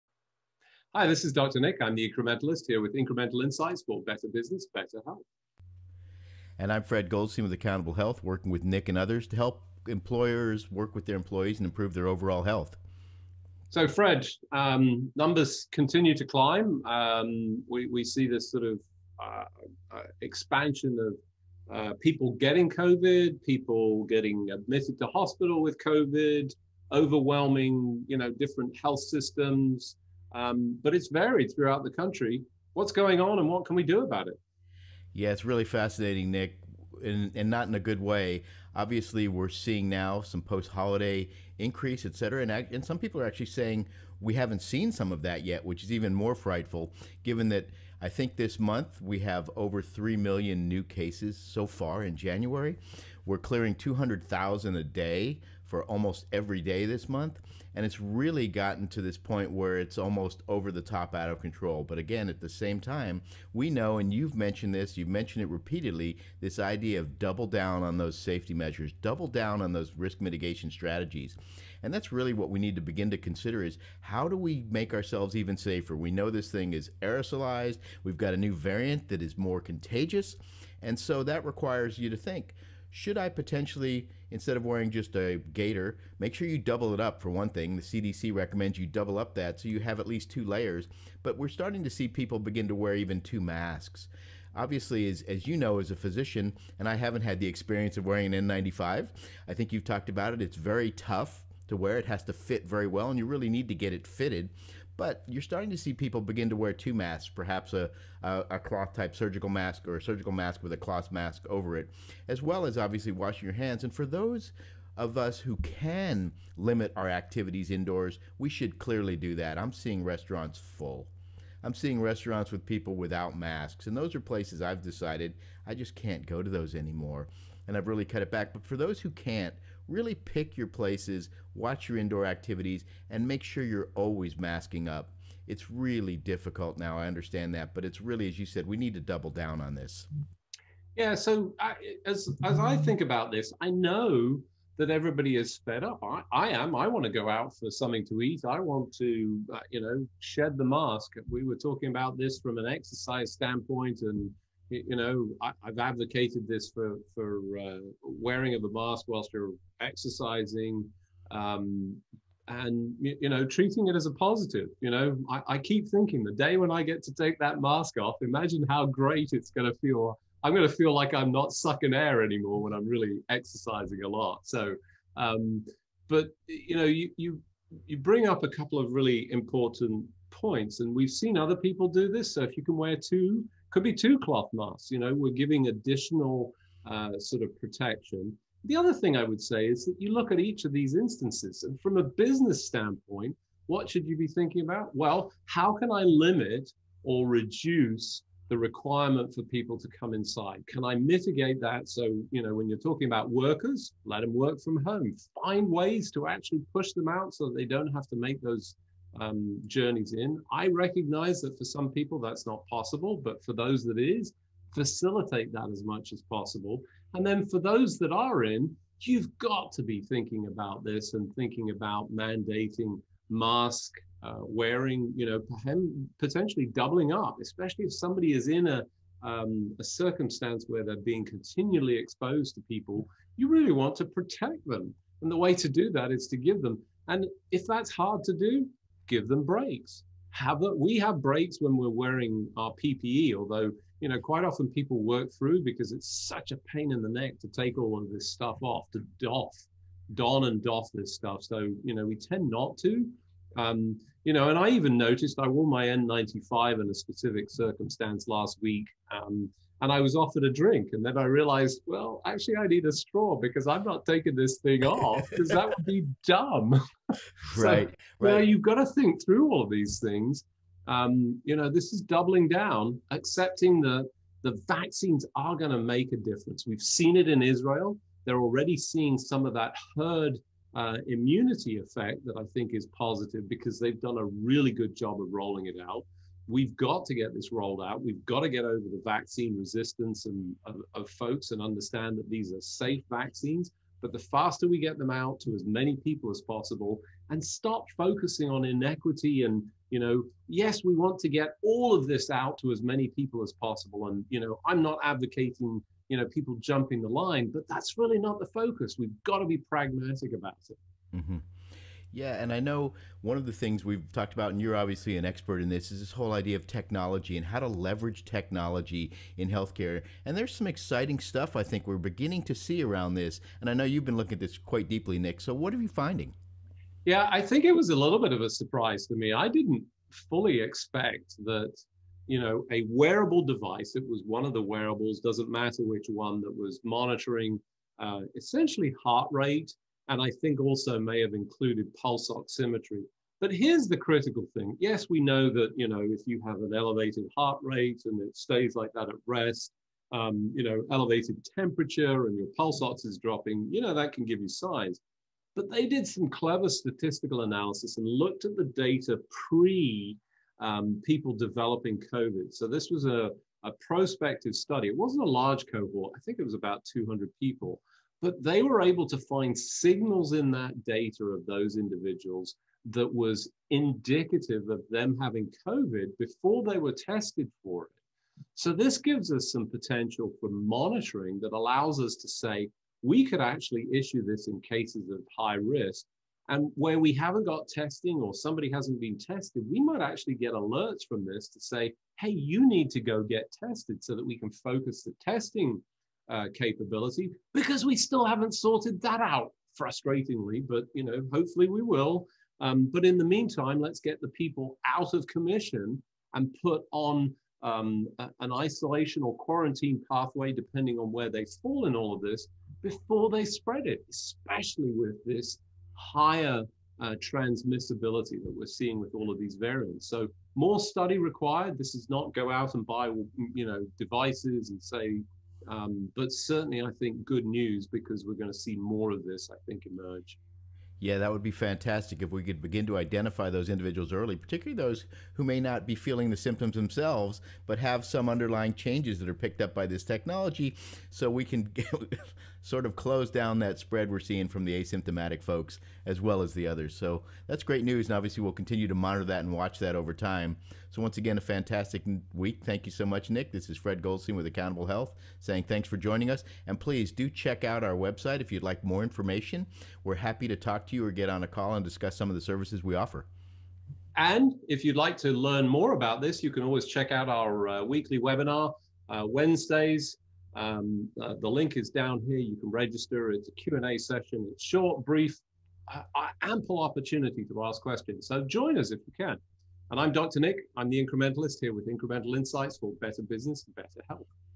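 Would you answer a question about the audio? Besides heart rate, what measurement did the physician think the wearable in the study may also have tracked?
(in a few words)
pulse oximetry.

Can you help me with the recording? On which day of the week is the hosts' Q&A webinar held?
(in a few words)
Wednesdays.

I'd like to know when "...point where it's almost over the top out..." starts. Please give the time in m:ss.
0:59.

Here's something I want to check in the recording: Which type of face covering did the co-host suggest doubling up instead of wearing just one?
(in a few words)
a gaiter.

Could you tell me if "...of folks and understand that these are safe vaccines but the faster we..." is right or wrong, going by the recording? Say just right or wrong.
right.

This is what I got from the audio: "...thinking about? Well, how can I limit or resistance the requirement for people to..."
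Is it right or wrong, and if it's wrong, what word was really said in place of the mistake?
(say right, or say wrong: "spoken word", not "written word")
wrong: "reduce", not "resistance".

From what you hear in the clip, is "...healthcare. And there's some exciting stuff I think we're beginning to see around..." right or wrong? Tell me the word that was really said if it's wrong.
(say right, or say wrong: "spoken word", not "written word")
right.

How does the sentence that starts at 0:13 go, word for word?
So, Fred, um, numbers continue to climb.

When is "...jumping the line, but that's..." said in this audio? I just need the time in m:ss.
5:06.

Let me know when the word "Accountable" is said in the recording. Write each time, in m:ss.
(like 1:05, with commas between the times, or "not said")
0:07, 7:34.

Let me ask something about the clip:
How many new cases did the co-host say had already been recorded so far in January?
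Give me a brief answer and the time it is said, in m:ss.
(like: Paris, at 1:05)
over 3 million, at 0:49.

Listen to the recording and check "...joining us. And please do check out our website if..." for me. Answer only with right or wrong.
right.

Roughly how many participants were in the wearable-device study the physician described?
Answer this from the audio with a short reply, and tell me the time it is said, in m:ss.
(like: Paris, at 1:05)
about 200, at 6:06.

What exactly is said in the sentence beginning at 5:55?
But they did some clever statistical analysis and looked at the data pre um, people developing COVID.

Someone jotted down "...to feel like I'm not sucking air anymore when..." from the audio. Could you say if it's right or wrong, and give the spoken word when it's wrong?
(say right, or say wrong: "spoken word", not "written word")
right.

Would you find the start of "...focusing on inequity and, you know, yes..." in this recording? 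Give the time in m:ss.
4:57.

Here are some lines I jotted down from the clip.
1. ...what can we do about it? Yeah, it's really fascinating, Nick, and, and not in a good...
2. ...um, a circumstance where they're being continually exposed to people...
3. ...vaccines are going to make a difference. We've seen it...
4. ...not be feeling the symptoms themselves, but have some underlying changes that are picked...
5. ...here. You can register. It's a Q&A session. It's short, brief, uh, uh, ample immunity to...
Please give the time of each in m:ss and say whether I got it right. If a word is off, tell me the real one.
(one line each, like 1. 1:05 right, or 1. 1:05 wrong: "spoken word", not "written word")
1. 0:33 right
2. 3:49 right
3. 4:34 right
4. 7:15 right
5. 7:52 wrong: "opportunity", not "immunity".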